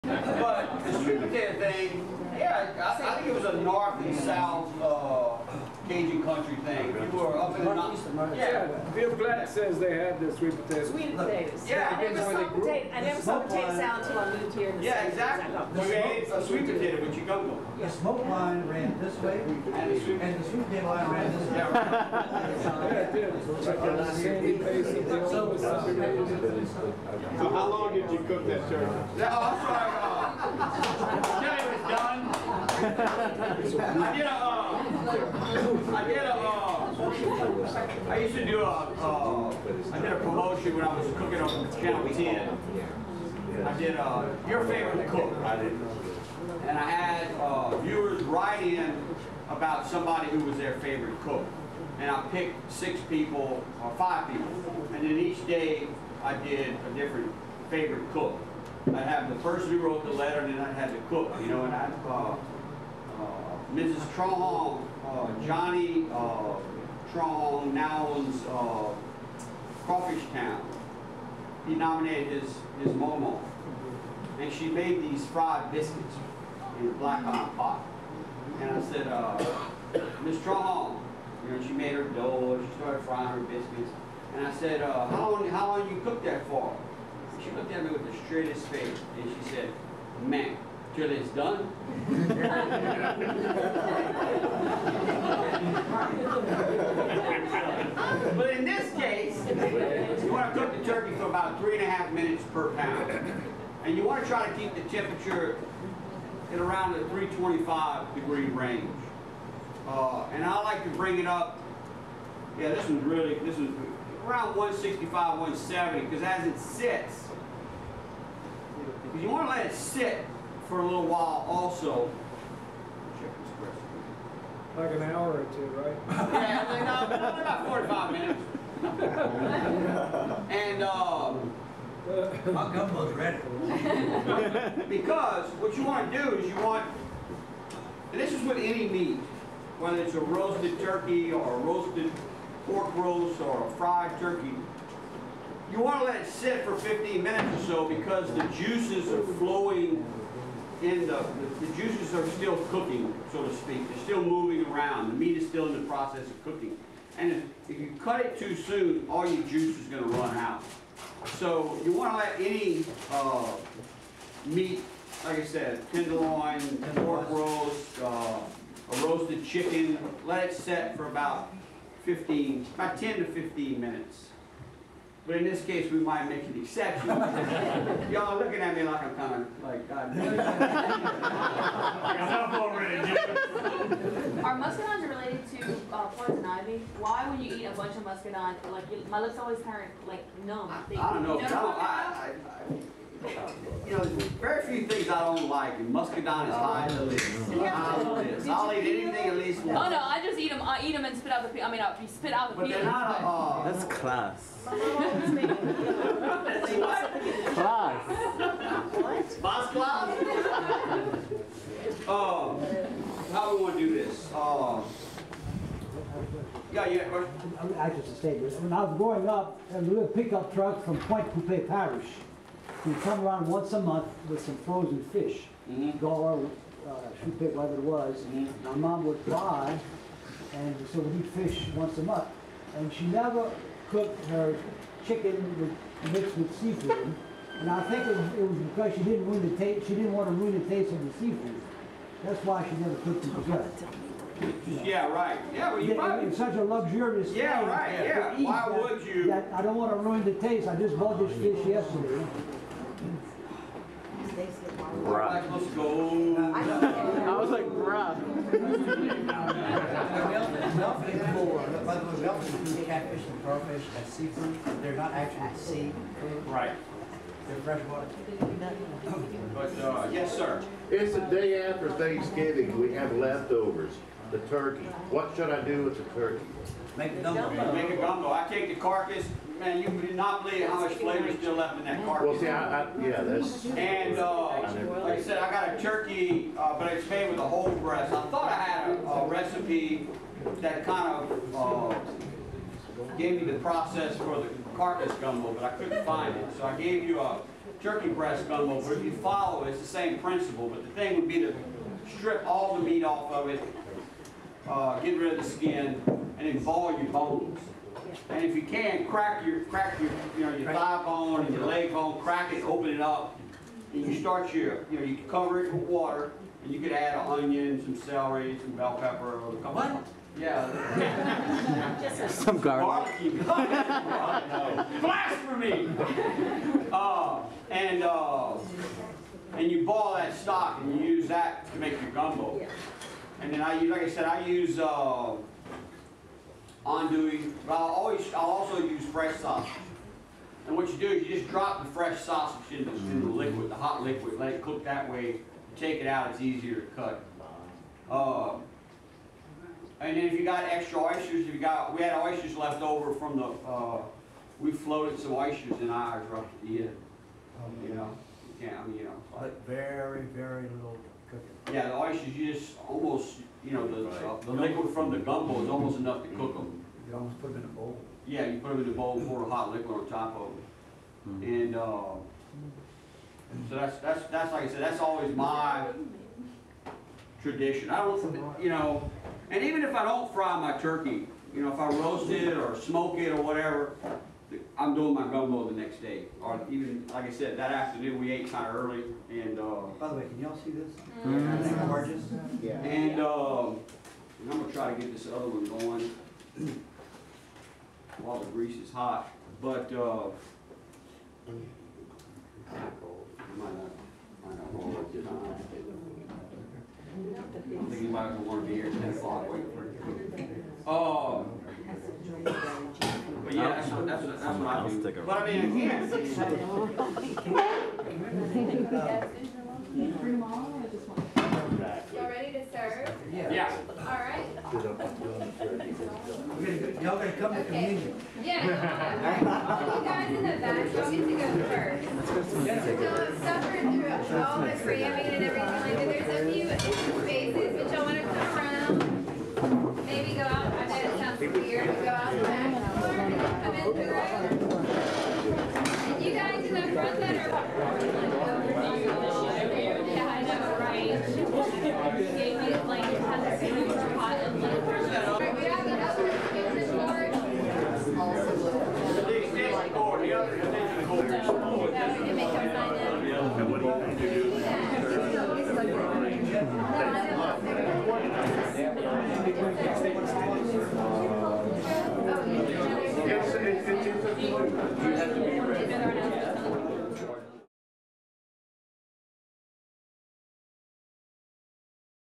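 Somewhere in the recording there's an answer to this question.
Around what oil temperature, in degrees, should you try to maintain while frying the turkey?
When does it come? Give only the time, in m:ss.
1:47.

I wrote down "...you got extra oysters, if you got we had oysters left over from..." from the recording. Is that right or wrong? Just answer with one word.
right.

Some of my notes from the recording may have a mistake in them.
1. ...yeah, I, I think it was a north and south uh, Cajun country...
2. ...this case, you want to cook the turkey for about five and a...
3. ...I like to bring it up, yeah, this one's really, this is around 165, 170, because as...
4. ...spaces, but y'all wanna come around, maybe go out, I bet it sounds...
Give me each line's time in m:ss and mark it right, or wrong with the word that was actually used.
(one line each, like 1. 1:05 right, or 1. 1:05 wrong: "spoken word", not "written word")
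1. 0:02 right
2. 1:38 wrong: "three", not "five"
3. 1:50 right
4. 7:17 right.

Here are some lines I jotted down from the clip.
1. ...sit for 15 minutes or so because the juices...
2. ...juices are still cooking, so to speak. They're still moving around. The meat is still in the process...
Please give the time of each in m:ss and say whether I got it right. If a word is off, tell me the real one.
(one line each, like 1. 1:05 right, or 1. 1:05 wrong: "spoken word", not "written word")
1. 2:26 right
2. 2:31 right.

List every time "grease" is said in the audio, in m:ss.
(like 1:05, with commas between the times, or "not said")
6:38.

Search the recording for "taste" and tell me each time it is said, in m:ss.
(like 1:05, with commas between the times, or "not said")
4:00, 4:10.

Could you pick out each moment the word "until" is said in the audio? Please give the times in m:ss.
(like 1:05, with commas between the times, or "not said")
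0:14.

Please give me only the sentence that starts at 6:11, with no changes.
And, uh, so that's, that's, that's like I said, that's always my tradition.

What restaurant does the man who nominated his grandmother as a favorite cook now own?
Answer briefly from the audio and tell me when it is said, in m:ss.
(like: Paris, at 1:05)
Crawfish Town, at 1:09.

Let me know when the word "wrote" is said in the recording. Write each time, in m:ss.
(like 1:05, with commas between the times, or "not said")
0:59.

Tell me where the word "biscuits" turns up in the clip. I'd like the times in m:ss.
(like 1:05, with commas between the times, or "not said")
1:15, 1:23.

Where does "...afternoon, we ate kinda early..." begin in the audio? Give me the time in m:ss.
6:27.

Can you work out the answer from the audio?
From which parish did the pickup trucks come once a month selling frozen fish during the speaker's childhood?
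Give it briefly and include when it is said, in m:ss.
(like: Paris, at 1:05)
Pointe Coupee Parish, at 3:40.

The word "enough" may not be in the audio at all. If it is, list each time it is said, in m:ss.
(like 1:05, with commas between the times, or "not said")
3:02, 6:05.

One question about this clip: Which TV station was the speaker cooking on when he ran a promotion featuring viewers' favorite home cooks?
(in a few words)
Channel 10.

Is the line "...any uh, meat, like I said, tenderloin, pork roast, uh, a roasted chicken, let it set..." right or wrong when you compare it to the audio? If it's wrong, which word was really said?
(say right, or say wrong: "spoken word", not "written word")
right.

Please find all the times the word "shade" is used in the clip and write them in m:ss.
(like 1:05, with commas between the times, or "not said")
not said.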